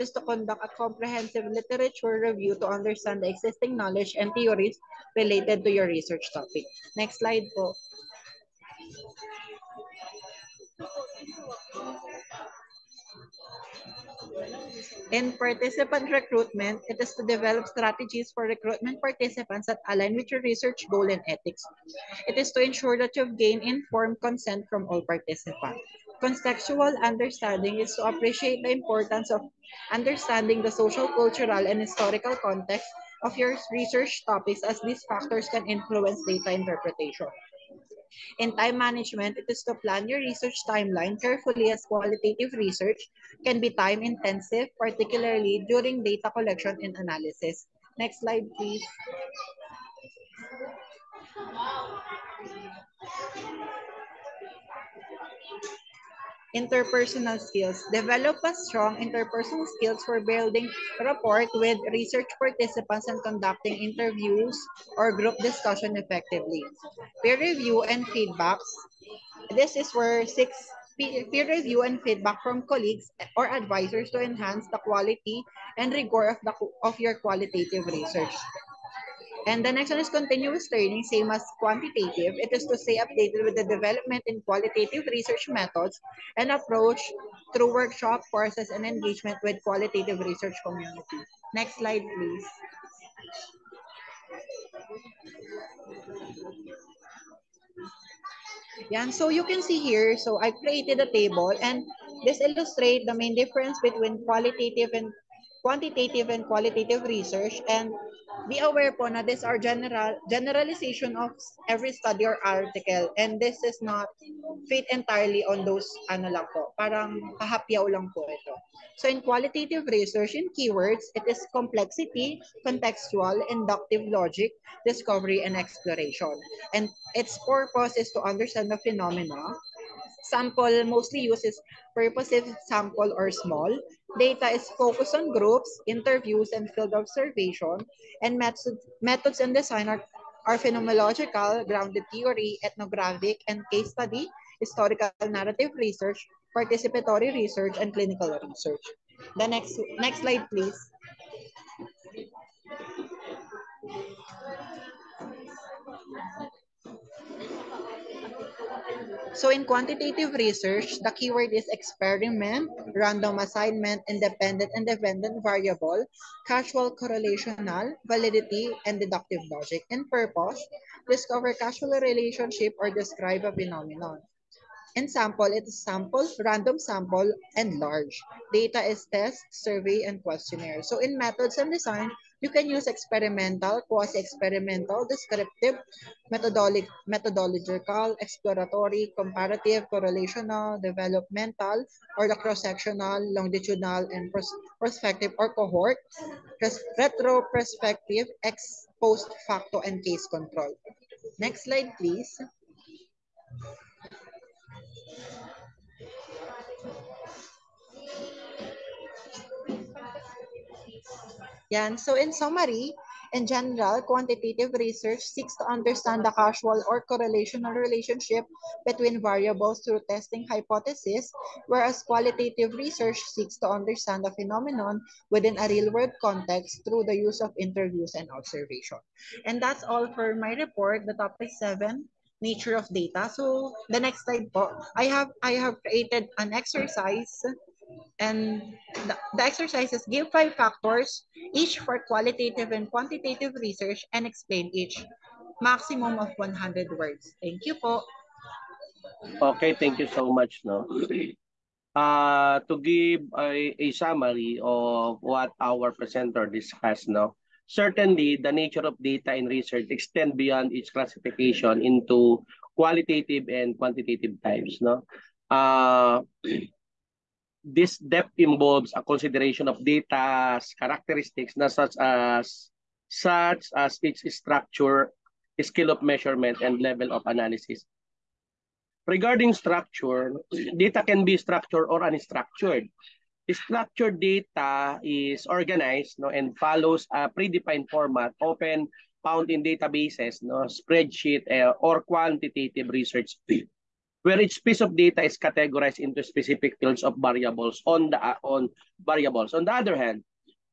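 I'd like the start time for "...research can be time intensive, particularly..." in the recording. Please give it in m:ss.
0:42.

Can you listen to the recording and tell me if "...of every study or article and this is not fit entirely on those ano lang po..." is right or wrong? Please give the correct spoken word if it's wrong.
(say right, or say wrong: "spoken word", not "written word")
right.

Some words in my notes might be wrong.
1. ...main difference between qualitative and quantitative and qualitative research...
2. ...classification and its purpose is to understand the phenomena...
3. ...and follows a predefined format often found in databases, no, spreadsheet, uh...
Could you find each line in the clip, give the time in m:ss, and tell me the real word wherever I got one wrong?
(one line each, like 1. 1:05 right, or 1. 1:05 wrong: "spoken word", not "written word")
1. 1:43 right
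2. 2:05 wrong: "exploration", not "classification"
3. 4:46 right.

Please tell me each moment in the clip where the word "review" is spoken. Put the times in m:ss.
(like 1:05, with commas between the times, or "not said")
0:02, 1:07, 1:11.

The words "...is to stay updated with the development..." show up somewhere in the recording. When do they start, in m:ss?
1:22.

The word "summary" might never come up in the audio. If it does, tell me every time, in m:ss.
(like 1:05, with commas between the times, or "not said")
3:32, 4:13.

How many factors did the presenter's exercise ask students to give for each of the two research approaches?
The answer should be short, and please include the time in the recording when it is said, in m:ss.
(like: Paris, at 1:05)
5, at 4:00.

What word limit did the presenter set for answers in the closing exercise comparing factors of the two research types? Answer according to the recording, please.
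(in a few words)
100 words.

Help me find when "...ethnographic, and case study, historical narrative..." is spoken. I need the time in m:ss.
2:22.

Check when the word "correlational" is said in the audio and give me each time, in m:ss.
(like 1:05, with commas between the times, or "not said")
2:46, 3:09, 3:37.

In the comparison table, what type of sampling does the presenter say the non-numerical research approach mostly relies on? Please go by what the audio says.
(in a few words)
Purposive sample.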